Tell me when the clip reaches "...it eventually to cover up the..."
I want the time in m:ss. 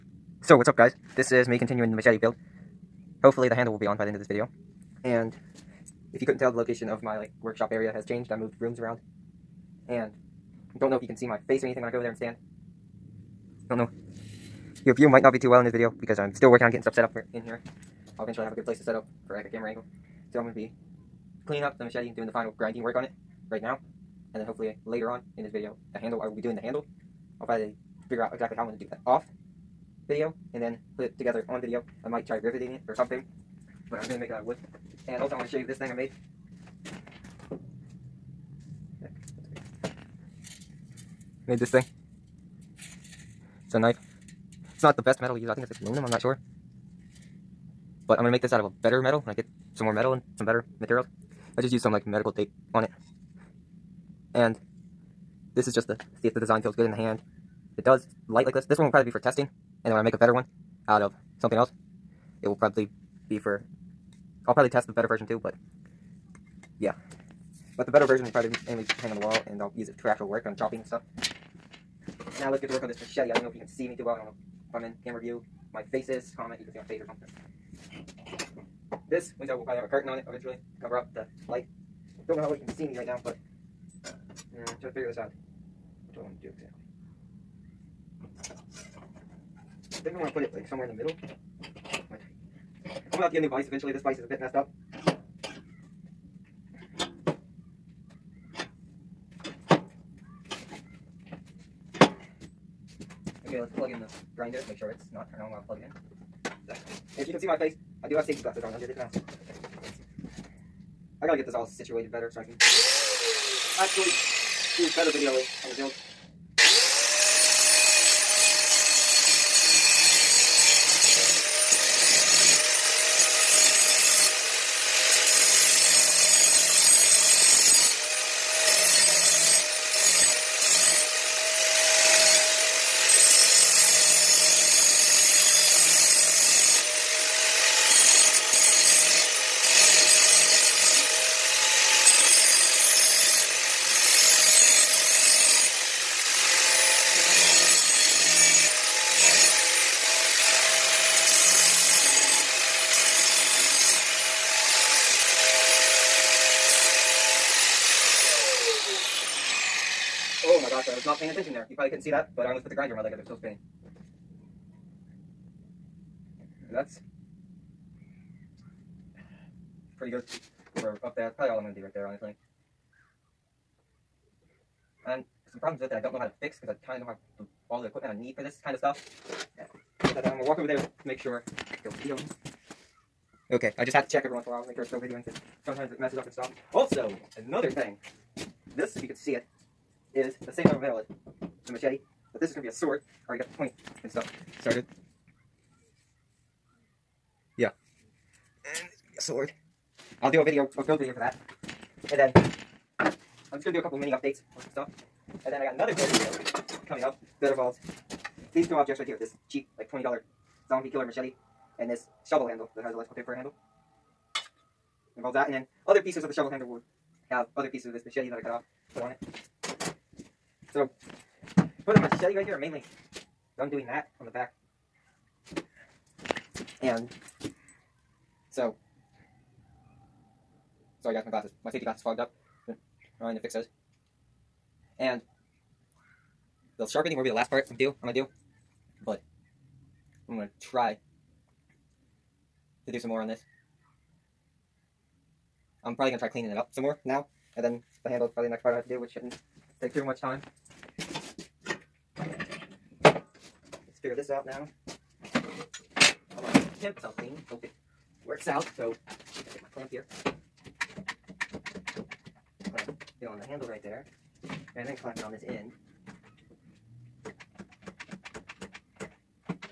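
1:20.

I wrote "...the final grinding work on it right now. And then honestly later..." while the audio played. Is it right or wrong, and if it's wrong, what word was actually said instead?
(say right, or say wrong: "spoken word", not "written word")
wrong: "hopefully", not "honestly".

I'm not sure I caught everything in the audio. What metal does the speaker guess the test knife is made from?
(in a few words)
aluminum.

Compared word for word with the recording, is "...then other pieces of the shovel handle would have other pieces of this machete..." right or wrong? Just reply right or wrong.
right.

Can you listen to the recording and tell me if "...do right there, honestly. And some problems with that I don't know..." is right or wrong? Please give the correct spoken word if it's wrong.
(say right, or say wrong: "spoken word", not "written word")
right.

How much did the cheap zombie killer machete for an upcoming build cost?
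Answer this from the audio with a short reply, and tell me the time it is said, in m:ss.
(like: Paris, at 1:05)
$20, at 3:29.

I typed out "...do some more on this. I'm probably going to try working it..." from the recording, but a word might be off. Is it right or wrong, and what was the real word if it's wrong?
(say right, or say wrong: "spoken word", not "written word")
wrong: "cleaning", not "working".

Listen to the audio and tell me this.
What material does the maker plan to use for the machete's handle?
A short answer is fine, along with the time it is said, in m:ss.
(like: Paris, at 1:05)
wood, at 0:34.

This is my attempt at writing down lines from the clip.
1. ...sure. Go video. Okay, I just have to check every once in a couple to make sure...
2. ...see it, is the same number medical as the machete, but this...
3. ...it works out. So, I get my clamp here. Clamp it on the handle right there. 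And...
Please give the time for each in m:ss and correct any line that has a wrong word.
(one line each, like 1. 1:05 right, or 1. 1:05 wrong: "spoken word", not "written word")
1. 3:01 wrong: "while", not "couple"
2. 3:09 wrong: "metal", not "medical"
3. 4:17 right.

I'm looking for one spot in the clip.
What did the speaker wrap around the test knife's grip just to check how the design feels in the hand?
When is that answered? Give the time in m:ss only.
0:52.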